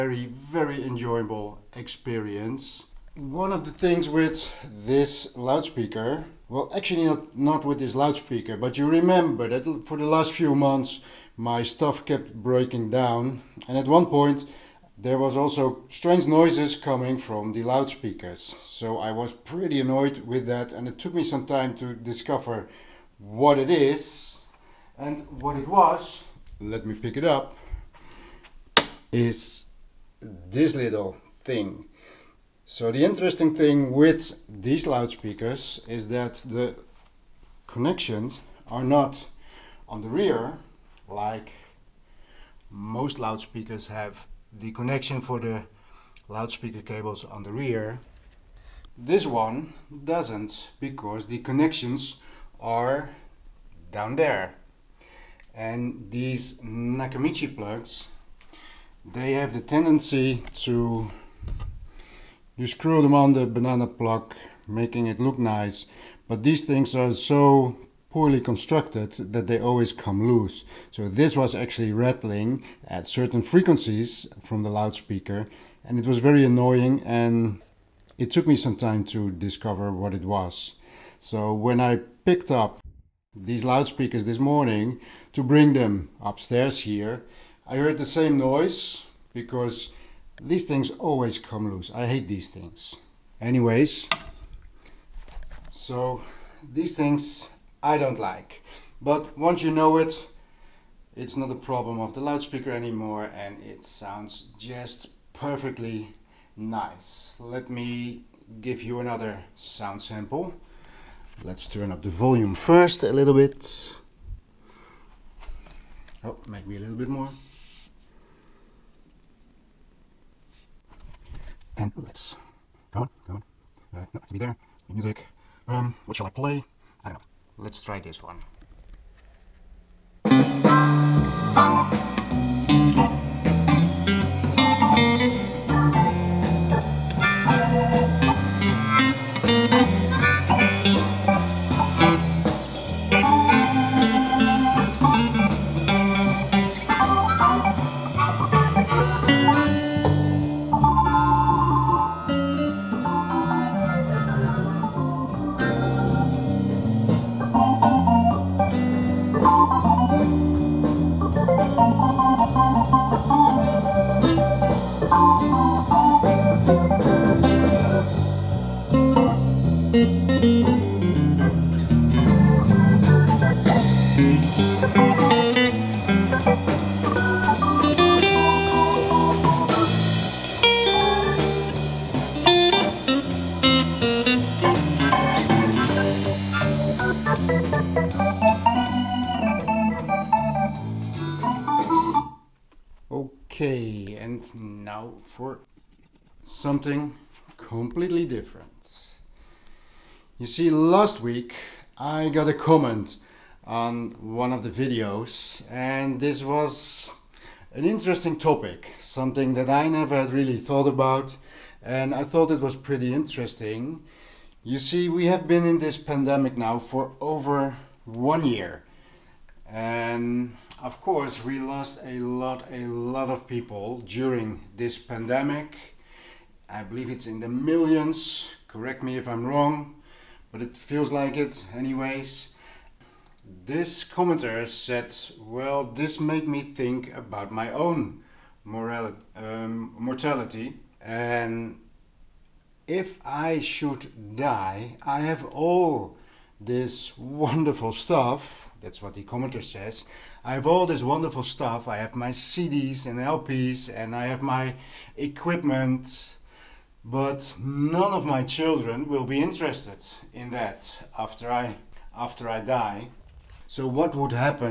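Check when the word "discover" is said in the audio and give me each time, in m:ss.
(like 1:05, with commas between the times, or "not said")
0:21, 1:19.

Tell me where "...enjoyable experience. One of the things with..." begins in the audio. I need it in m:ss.
0:00.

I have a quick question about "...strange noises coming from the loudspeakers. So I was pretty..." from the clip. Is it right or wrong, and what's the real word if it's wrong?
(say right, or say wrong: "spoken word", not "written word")
right.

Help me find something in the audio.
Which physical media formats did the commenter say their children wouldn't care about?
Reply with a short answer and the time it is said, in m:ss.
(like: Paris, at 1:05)
CDs and LPs, at 4:12.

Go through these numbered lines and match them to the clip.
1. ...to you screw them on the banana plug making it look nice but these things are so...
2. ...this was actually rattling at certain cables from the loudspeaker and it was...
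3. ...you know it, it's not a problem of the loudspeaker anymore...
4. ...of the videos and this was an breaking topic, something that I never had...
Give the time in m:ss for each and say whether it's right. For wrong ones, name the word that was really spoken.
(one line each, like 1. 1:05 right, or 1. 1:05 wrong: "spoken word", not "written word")
1. 1:00 right
2. 1:11 wrong: "frequencies", not "cables"
3. 1:39 right
4. 3:24 wrong: "interesting", not "breaking".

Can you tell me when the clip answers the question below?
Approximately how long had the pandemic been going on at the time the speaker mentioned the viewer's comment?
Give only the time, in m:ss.
3:37.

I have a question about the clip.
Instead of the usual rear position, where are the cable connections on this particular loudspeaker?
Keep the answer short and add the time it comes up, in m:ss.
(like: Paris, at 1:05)
down there, at 0:53.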